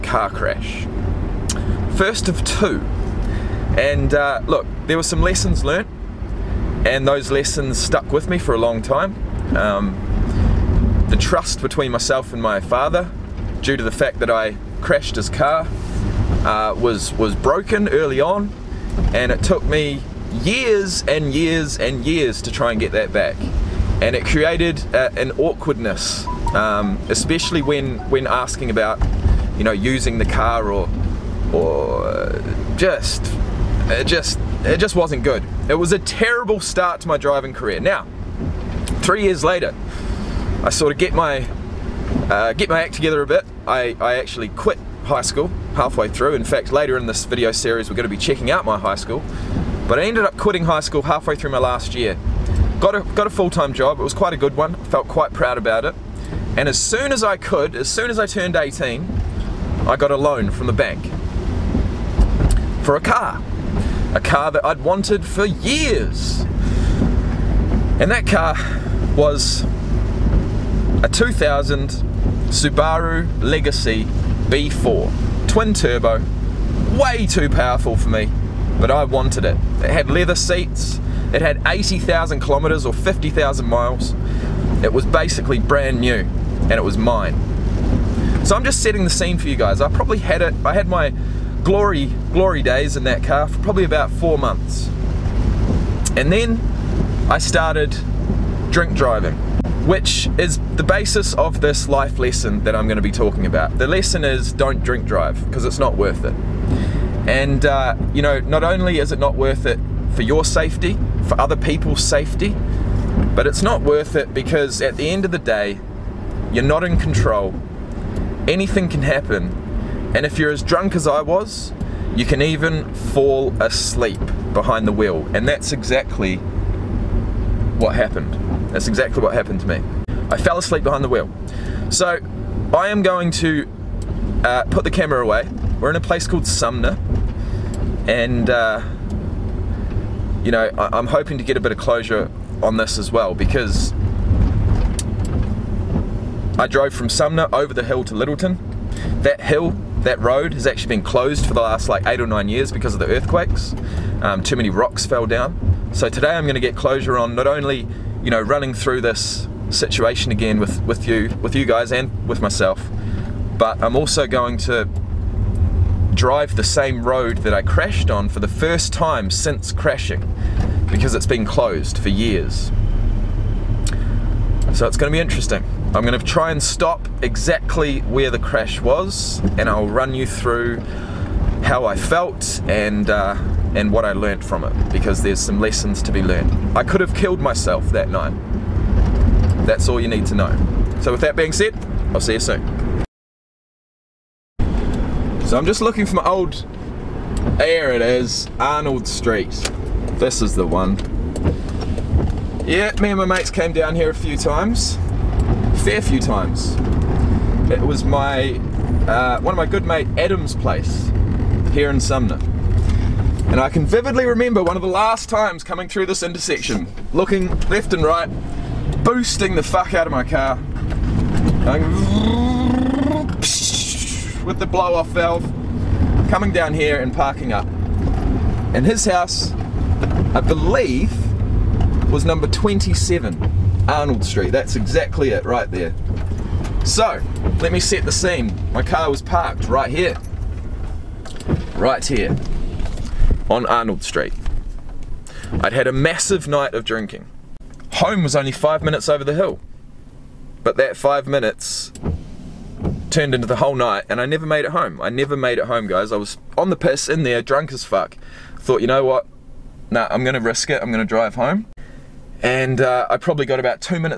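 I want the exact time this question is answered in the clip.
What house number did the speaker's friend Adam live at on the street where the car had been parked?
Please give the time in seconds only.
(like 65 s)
232 s.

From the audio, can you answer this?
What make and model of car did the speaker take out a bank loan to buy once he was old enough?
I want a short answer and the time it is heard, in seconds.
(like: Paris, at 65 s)
Subaru Legacy B4, at 72 s.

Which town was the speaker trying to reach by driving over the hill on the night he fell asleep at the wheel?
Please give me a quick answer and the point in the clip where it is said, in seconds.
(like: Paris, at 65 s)
Lyttelton, at 148 s.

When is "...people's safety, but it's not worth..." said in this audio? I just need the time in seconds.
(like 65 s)
111 s.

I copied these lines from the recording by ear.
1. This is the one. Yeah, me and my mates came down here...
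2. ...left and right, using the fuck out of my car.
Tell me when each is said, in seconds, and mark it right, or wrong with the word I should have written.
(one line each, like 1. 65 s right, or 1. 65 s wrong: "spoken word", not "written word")
1. 200 s right
2. 217 s wrong: "boosting", not "using".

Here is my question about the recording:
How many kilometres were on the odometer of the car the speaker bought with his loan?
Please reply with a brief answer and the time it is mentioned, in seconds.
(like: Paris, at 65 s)
80,000, at 81 s.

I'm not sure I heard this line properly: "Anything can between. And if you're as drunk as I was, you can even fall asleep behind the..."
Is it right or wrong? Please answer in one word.
wrong.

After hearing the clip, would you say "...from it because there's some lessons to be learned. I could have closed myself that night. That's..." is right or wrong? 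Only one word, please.
wrong.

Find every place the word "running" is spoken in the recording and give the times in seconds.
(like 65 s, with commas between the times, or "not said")
158 s.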